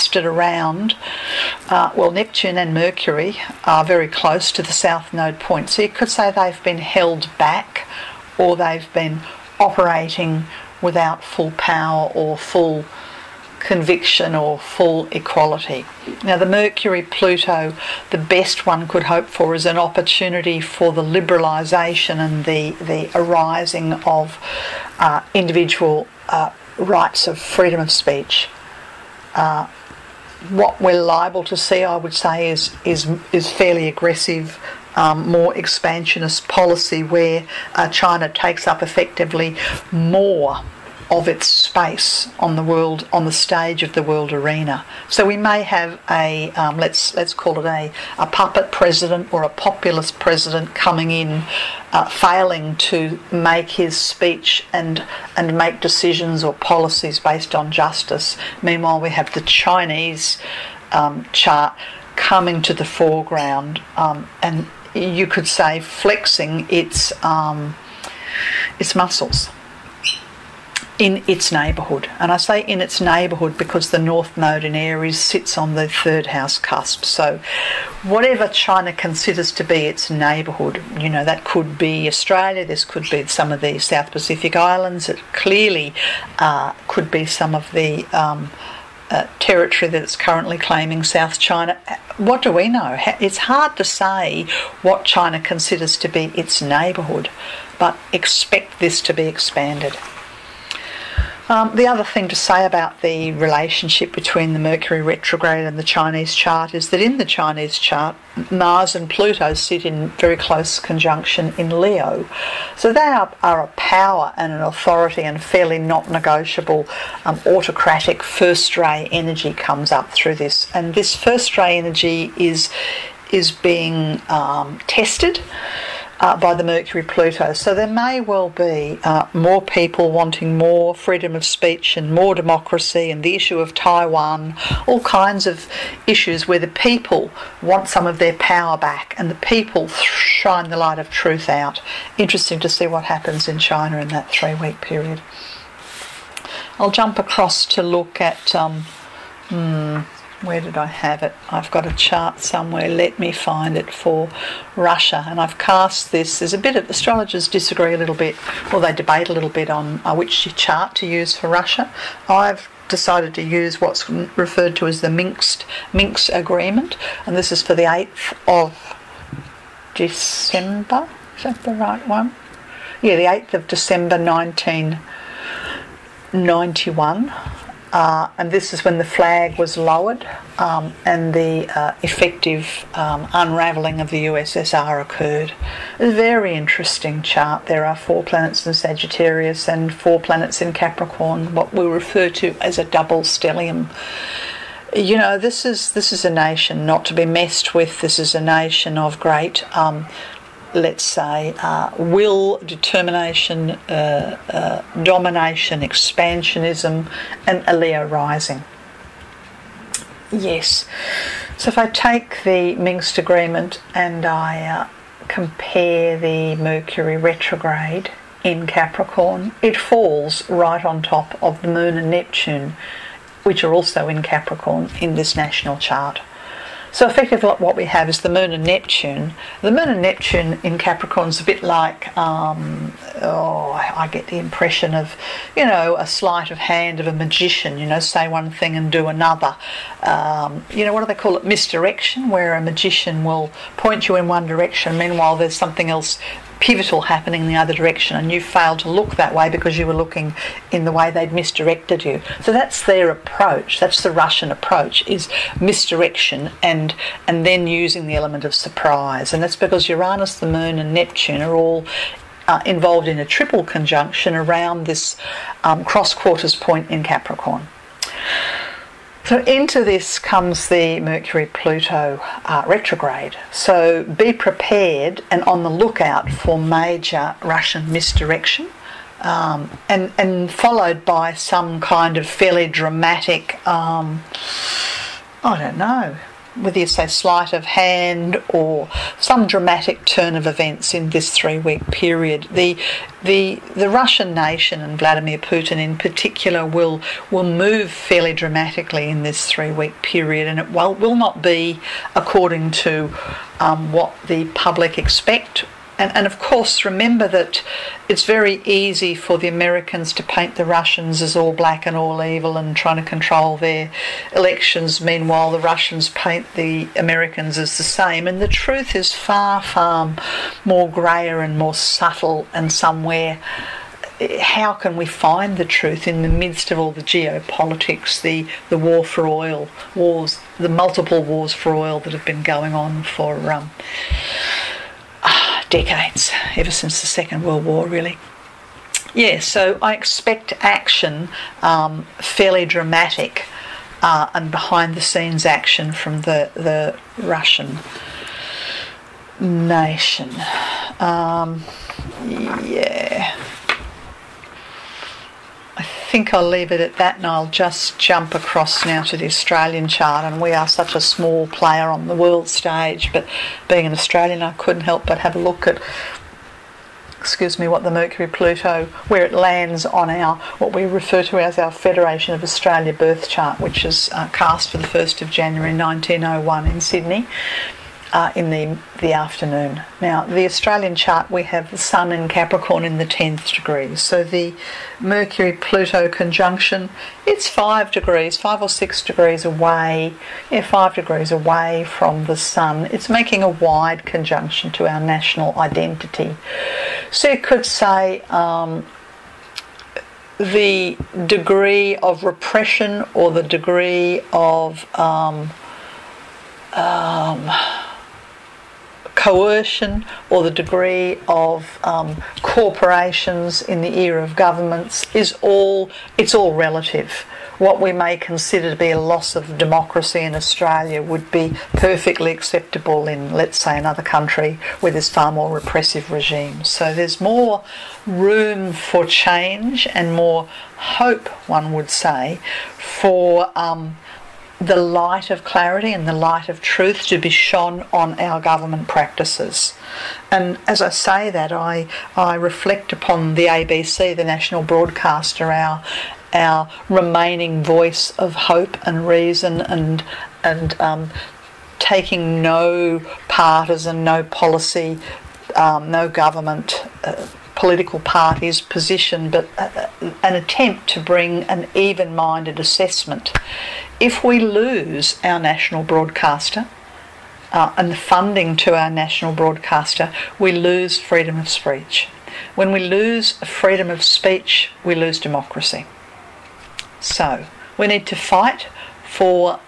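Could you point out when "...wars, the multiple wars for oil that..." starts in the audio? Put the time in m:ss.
5:29.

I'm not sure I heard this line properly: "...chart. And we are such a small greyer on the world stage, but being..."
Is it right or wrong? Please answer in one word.
wrong.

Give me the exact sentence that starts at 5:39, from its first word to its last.
Yeah, so I expect action, um, fairly dramatic uh, and behind the scenes action from the, the Russian nation.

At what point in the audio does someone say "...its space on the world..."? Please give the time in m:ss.
0:41.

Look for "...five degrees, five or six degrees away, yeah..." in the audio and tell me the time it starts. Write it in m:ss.
6:27.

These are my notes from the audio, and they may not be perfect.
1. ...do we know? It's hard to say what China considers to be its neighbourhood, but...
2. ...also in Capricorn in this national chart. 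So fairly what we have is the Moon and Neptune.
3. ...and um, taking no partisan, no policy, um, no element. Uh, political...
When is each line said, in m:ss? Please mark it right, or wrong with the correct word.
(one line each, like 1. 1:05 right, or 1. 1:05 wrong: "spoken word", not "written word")
1. 1:32 right
2. 3:43 wrong: "effectively", not "fairly"
3. 7:30 wrong: "government", not "element".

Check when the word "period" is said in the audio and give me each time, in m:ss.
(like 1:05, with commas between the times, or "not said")
2:24, 4:51, 5:00.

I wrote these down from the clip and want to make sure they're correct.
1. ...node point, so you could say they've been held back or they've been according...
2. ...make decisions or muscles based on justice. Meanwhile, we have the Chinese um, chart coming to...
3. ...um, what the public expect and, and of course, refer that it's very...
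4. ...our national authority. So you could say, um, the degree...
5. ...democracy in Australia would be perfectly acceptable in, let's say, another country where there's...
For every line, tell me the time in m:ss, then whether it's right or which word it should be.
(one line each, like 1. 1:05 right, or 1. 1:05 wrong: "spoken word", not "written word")
1. 0:05 wrong: "operating", not "according"
2. 0:55 wrong: "policies", not "muscles"
3. 5:03 wrong: "remember", not "refer"
4. 6:34 wrong: "identity", not "authority"
5. 6:59 right.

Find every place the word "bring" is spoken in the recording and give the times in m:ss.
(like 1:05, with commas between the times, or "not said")
7:40.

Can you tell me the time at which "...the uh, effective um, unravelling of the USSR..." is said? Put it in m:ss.
3:01.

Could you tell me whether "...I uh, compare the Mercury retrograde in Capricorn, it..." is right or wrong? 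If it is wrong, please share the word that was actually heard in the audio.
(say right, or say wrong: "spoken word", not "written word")
right.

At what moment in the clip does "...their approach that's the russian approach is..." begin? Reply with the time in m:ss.
4:12.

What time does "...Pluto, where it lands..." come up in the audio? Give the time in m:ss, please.
6:08.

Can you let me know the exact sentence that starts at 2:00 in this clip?
And this first ray energy is, is being um, tested uh, by the Mercury Pluto.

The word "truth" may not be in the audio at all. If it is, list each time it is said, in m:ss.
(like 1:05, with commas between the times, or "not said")
2:21, 5:18, 5:25, 7:16.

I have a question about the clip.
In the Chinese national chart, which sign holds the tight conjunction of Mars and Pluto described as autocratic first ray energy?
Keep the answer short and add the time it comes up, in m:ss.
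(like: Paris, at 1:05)
Leo, at 1:51.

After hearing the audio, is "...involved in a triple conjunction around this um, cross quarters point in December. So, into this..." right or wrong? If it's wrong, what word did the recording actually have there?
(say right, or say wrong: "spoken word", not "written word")
wrong: "Capricorn", not "December".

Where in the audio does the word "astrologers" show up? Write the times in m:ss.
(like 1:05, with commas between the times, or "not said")
2:36.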